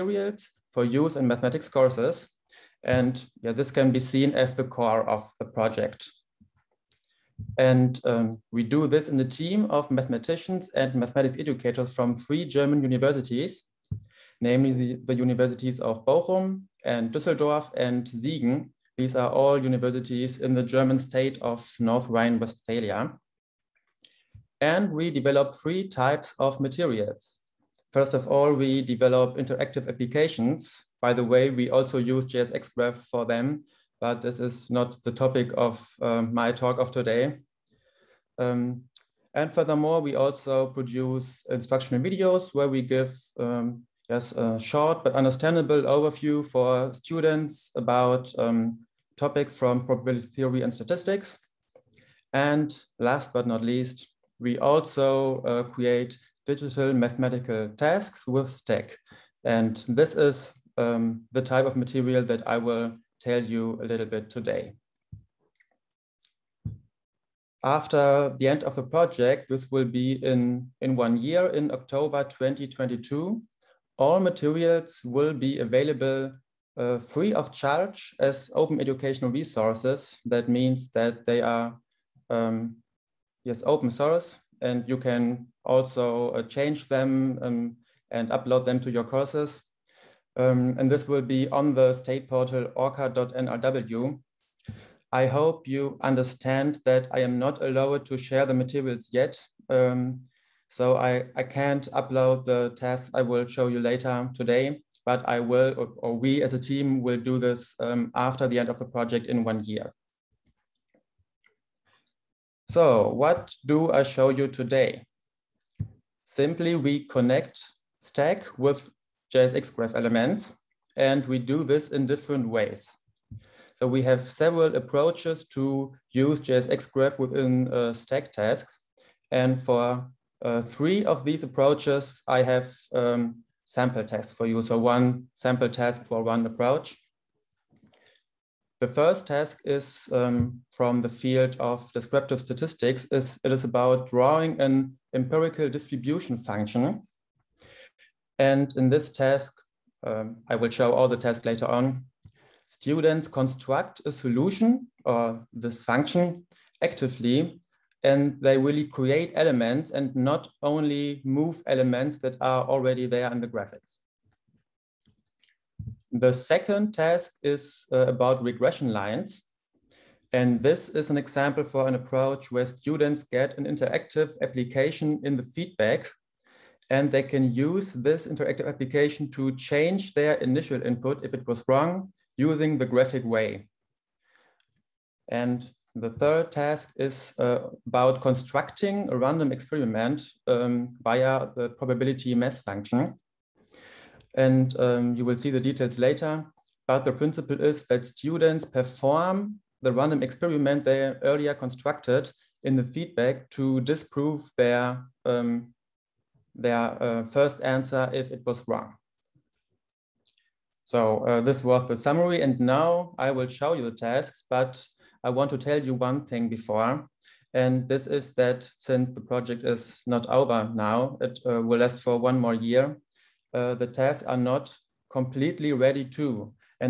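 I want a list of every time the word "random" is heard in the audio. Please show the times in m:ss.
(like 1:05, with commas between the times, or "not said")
3:09, 3:19.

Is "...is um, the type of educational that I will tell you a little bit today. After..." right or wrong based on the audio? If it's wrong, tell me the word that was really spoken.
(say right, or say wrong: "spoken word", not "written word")
wrong: "material", not "educational".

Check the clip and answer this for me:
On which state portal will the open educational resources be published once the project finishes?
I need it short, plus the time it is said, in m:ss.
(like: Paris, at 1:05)
orca.nrw, at 1:32.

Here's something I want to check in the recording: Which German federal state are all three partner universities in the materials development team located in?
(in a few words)
North Rhine-Westphalia.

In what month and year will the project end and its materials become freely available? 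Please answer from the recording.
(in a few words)
October 2022.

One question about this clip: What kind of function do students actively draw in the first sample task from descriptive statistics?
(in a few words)
empirical distribution function.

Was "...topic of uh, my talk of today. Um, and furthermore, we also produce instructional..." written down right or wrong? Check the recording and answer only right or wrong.
right.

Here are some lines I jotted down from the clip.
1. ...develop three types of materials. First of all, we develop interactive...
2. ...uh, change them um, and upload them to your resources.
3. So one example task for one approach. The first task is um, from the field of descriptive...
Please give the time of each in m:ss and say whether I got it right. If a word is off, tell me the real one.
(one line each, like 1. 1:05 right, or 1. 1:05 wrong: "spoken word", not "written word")
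1. 0:25 right
2. 1:26 wrong: "courses", not "resources"
3. 2:14 wrong: "sample", not "example".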